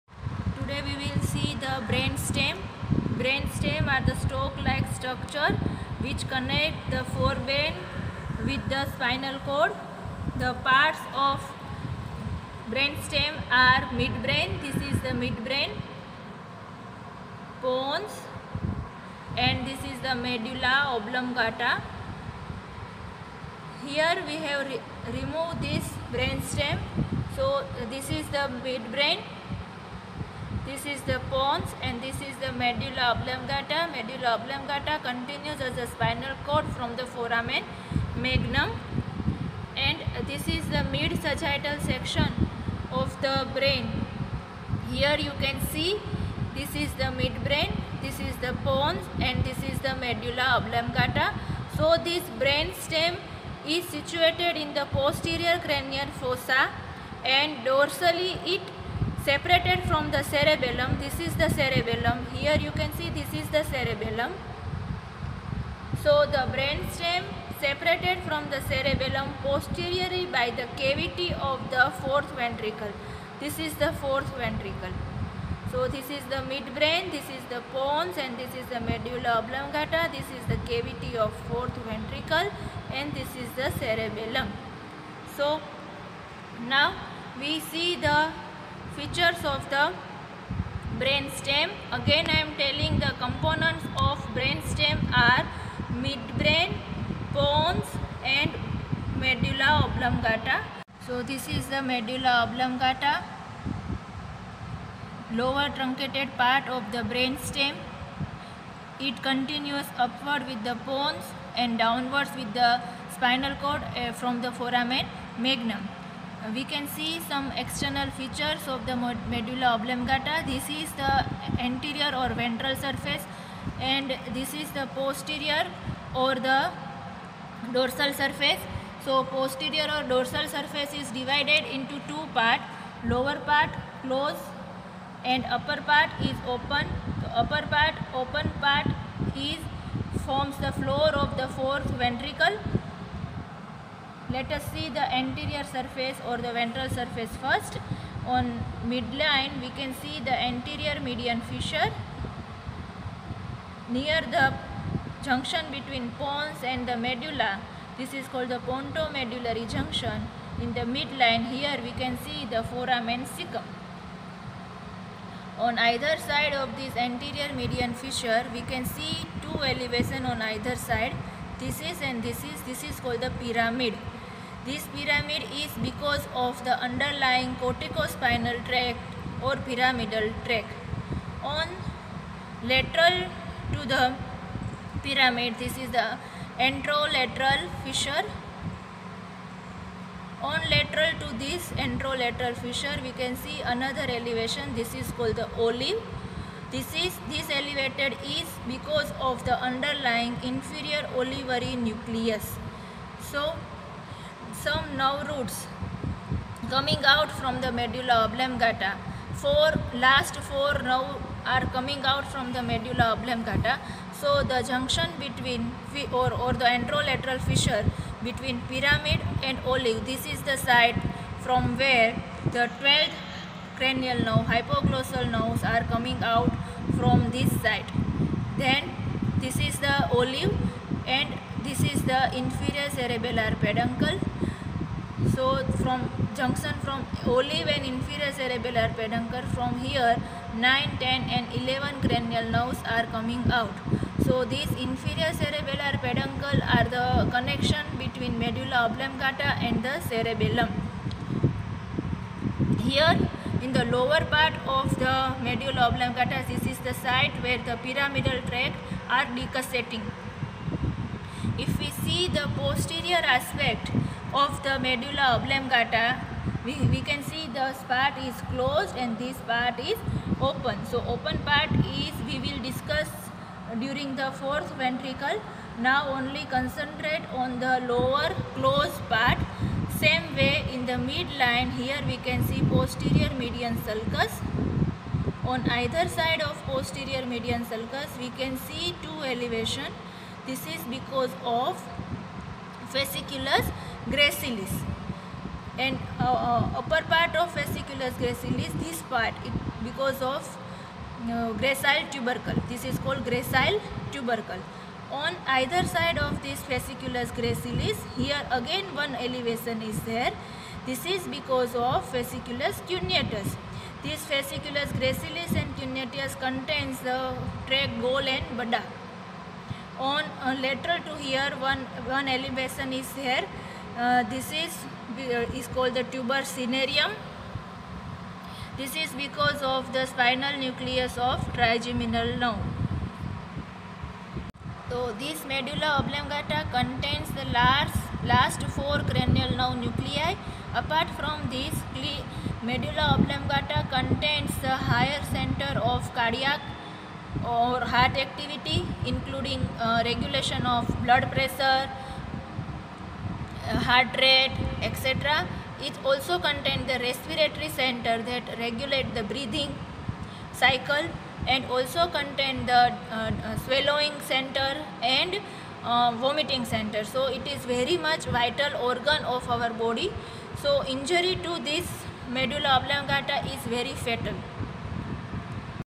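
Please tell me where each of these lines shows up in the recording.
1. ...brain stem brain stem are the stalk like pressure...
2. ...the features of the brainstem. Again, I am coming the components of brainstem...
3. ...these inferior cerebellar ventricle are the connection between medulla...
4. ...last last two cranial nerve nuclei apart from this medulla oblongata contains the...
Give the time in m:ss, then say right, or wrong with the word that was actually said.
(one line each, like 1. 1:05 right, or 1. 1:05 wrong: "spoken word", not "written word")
1. 0:01 wrong: "structure", not "pressure"
2. 1:27 wrong: "telling", not "coming"
3. 4:04 wrong: "peduncle", not "ventricle"
4. 5:37 wrong: "four", not "two".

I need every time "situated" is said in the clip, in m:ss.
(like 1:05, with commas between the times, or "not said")
0:53.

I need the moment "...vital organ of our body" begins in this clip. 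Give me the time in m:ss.
6:08.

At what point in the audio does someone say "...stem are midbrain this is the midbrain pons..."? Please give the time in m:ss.
0:13.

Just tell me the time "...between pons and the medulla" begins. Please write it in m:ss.
2:35.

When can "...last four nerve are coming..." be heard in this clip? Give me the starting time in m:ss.
3:30.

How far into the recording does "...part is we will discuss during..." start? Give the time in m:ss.
4:31.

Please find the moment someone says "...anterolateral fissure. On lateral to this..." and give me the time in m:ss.
3:06.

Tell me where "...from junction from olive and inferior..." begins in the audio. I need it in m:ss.
3:55.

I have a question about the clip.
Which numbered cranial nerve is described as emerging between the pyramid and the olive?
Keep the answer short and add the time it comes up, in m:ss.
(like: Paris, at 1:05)
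12th (hypoglossal), at 3:42.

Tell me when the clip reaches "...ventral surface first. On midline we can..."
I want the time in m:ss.
2:26.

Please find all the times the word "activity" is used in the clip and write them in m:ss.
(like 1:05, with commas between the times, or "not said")
5:48.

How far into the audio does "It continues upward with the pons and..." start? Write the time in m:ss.
1:48.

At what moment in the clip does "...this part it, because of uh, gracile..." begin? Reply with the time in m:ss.
4:58.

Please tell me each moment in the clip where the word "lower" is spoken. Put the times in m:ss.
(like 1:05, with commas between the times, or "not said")
1:45, 2:13, 4:13, 4:37.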